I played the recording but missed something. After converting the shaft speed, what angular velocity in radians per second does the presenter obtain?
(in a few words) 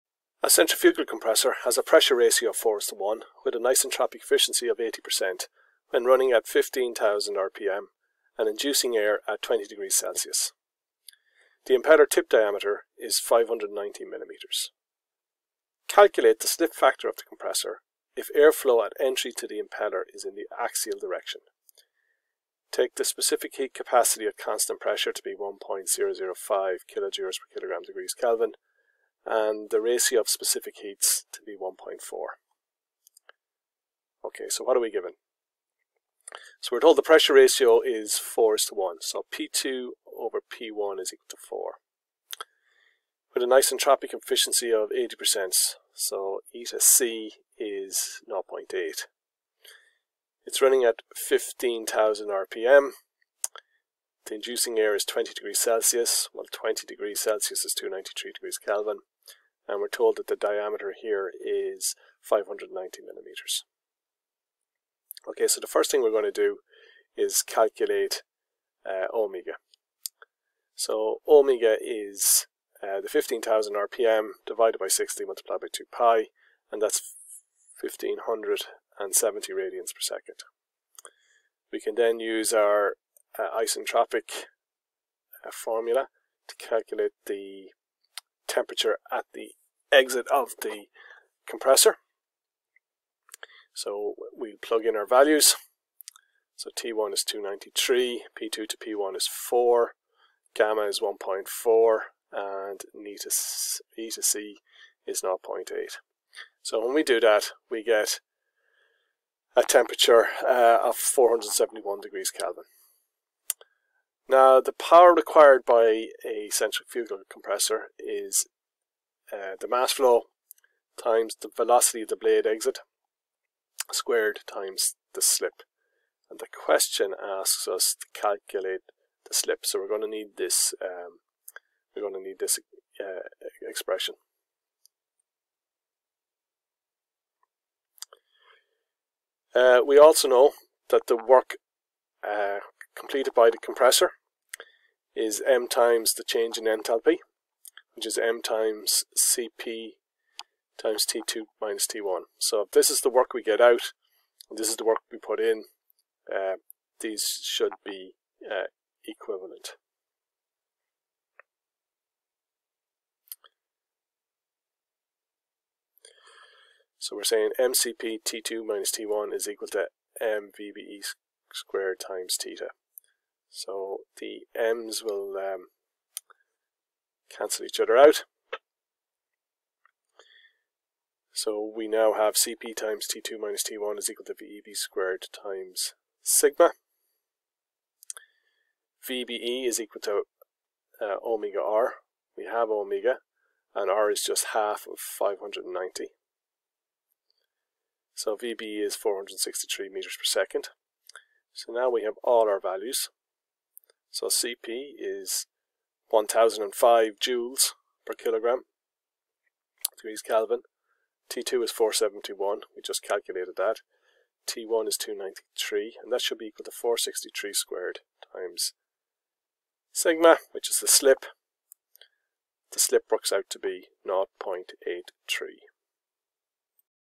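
1570 radians per second.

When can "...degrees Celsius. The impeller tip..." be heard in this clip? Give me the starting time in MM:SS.
00:09.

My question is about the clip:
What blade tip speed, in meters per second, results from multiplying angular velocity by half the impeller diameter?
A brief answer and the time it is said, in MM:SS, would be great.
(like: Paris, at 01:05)
463 m/s, at 03:18.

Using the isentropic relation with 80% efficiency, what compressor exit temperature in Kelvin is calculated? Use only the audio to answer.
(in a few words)
471 K.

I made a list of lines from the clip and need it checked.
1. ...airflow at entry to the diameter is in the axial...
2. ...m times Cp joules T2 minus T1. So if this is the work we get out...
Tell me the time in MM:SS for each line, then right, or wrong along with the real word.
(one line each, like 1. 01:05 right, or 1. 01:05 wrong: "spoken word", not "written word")
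1. 00:18 wrong: "impeller", not "diameter"
2. 02:28 wrong: "times", not "joules".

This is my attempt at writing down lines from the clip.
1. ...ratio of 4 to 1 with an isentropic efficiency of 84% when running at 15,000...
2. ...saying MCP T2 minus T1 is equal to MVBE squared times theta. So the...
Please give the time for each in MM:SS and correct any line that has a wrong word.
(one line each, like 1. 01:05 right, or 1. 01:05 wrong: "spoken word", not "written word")
1. 00:02 wrong: "80", not "84"
2. 02:47 right.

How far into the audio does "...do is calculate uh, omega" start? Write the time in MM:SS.
01:06.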